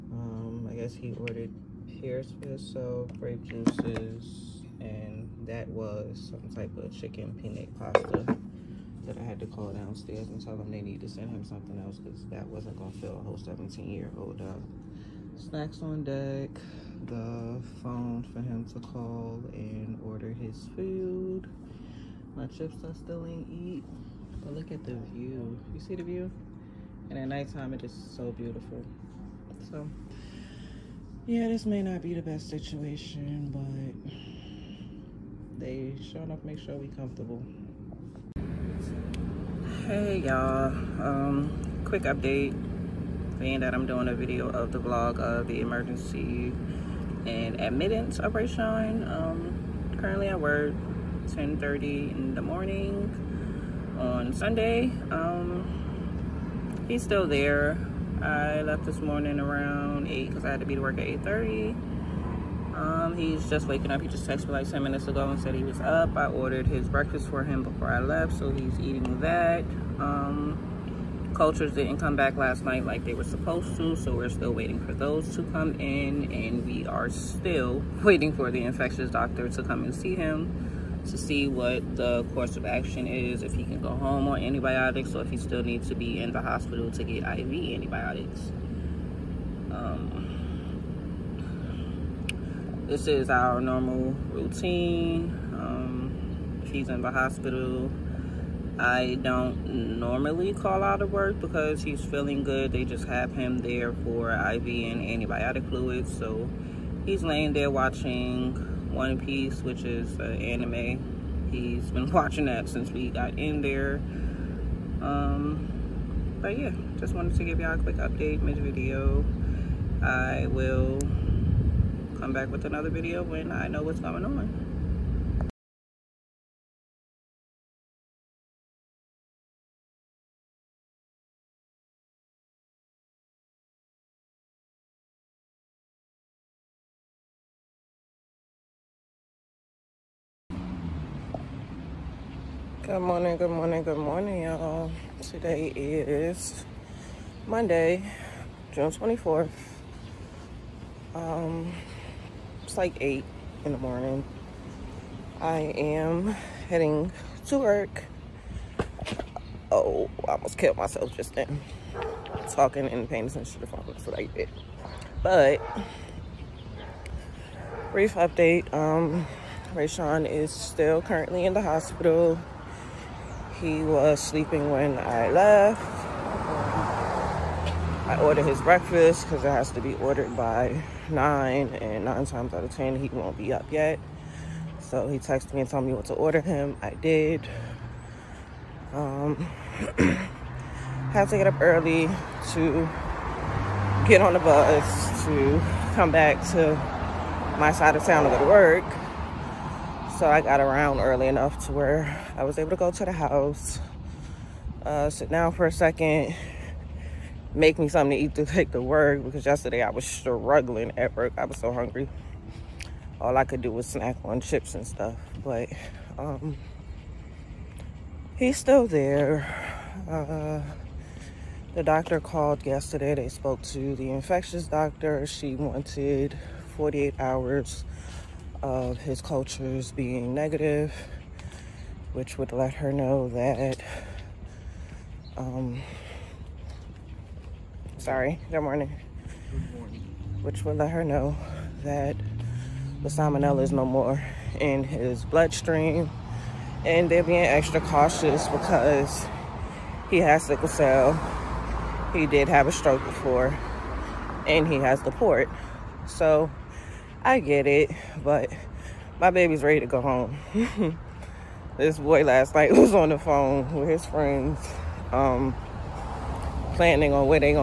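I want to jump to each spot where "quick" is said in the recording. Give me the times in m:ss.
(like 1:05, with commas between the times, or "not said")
0:41, 1:57.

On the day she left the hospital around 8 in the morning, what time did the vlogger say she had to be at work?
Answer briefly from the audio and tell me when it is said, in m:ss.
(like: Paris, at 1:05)
8:30, at 1:01.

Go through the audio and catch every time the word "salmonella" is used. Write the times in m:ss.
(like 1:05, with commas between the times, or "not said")
4:03.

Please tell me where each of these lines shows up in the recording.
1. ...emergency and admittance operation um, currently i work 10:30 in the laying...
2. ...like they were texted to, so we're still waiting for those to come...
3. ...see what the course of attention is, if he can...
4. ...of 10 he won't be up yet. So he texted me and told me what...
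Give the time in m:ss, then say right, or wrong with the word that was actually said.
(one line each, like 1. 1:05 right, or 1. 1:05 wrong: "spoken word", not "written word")
1. 0:45 wrong: "morning", not "laying"
2. 1:12 wrong: "supposed", not "texted"
3. 1:21 wrong: "action", not "attention"
4. 3:02 right.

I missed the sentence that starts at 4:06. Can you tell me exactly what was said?
And they're being extra cautious because he has sickle cell.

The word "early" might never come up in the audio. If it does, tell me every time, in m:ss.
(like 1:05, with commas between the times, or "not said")
3:11, 3:20.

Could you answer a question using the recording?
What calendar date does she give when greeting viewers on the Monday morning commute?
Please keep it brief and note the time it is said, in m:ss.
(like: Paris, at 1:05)
June 24th, at 2:28.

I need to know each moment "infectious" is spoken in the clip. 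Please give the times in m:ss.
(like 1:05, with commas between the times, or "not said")
1:18, 3:44.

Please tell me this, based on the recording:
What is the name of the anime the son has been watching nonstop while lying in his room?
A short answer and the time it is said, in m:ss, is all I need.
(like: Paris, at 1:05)
One Piece, at 1:48.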